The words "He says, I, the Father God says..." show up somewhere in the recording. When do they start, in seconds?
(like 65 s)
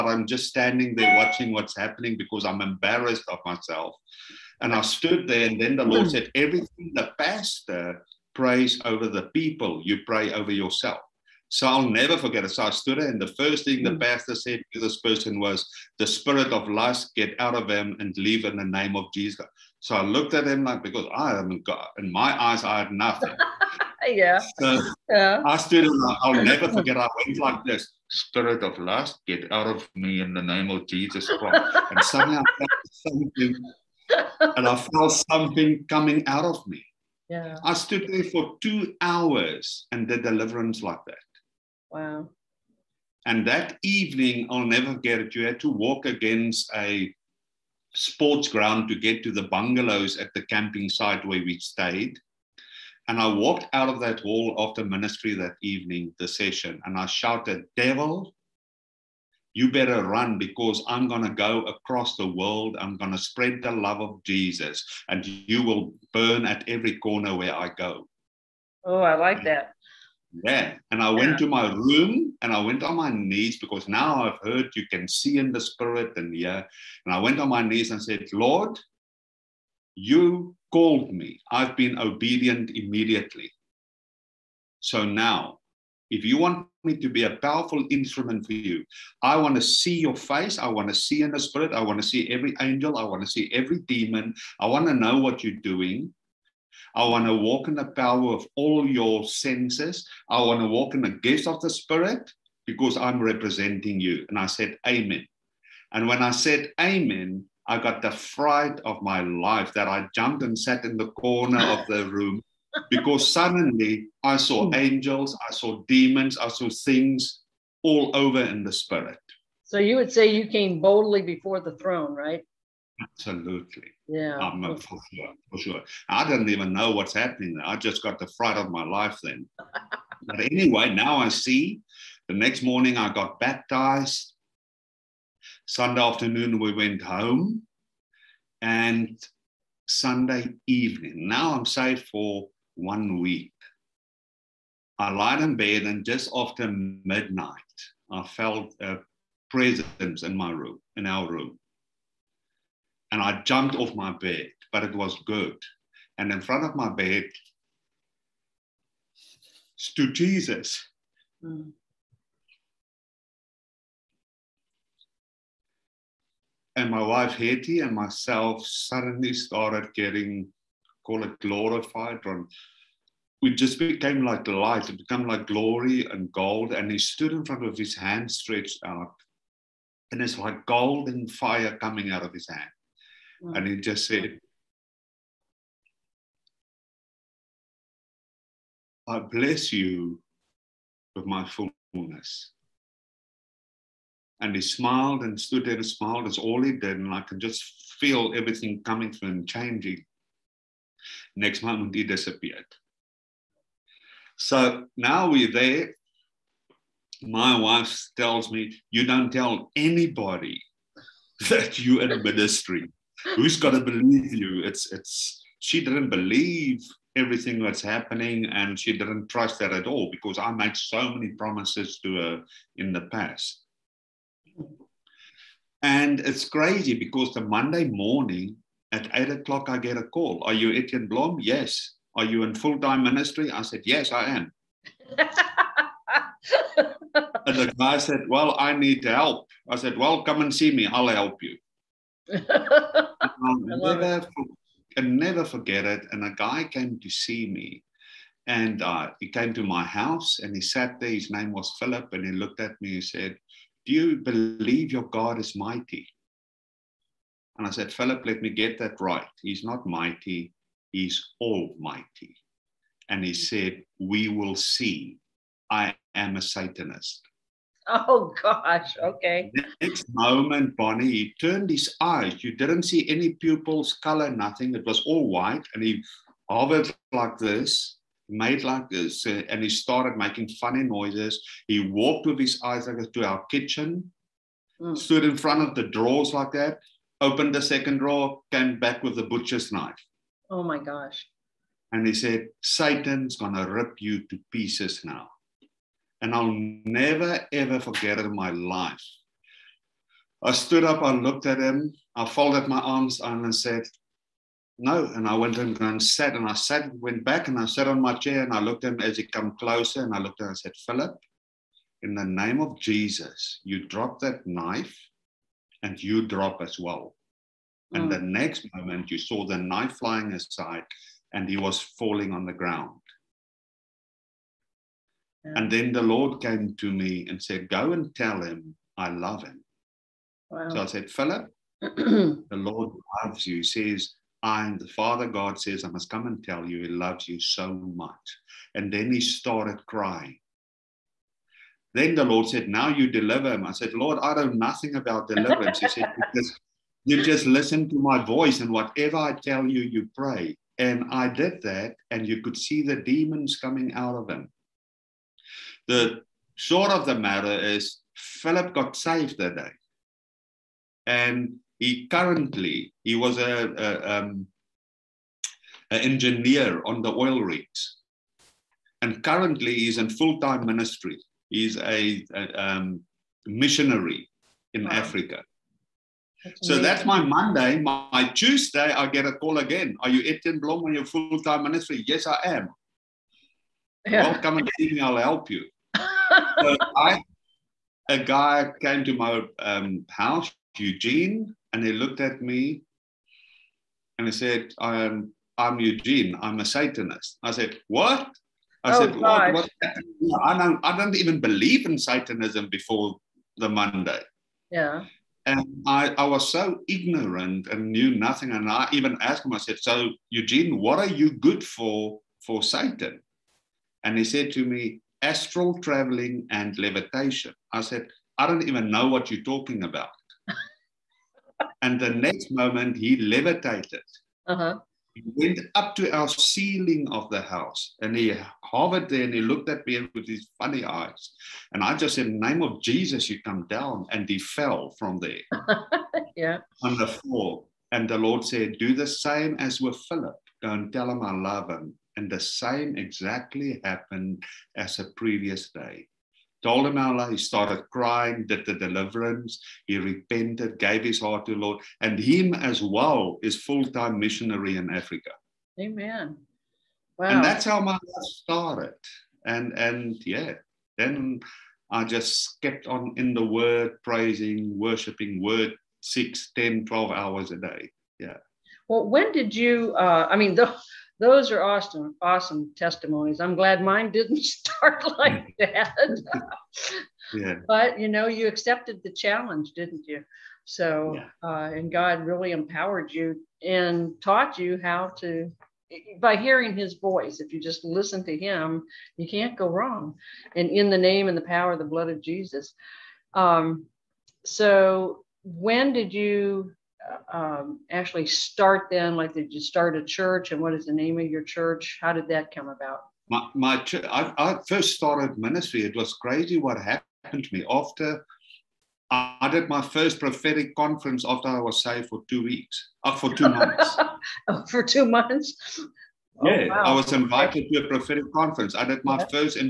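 333 s.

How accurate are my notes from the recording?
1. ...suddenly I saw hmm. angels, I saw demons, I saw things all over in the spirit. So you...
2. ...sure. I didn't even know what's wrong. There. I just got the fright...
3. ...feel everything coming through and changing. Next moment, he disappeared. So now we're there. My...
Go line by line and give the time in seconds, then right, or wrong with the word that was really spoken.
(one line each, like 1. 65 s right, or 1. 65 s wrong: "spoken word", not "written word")
1. 113 s right
2. 125 s wrong: "happening", not "wrong"
3. 197 s right.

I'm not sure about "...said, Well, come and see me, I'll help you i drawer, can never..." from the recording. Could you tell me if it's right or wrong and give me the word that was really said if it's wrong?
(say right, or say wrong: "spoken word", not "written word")
wrong: "never", not "drawer".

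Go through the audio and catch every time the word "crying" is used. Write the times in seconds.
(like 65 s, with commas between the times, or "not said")
339 s, 447 s.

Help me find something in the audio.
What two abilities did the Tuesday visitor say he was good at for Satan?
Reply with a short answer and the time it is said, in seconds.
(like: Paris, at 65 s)
Astral traveling and levitation, at 415 s.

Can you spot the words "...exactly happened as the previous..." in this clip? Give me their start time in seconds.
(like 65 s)
442 s.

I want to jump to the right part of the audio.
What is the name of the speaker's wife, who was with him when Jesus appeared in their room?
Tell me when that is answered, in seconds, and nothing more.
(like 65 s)
167 s.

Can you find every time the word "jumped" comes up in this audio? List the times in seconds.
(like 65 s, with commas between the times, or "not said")
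110 s, 153 s.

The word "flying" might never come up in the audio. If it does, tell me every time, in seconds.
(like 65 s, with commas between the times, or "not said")
319 s.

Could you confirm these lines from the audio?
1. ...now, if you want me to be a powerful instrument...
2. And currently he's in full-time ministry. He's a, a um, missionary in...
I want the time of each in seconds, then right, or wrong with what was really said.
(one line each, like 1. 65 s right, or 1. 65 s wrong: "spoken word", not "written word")
1. 85 s right
2. 369 s right.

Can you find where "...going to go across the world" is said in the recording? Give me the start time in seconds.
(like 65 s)
61 s.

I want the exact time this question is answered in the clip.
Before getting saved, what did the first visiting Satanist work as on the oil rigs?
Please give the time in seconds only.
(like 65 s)
365 s.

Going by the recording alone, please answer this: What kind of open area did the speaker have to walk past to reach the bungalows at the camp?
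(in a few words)
Sports ground.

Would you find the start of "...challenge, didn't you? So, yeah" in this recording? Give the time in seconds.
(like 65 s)
479 s.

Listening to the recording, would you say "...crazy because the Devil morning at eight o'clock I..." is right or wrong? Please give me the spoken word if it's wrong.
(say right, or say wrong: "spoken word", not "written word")
wrong: "Monday", not "Devil".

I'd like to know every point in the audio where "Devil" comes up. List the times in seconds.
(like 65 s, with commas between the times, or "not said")
57 s.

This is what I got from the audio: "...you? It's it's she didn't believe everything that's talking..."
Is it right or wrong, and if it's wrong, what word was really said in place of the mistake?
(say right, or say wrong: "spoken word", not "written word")
wrong: "happening", not "talking".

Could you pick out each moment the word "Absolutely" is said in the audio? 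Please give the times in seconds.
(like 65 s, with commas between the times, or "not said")
123 s.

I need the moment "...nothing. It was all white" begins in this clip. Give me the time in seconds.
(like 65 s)
274 s.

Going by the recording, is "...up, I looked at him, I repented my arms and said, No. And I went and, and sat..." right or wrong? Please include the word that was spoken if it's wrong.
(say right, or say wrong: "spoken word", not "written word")
wrong: "folded", not "repented".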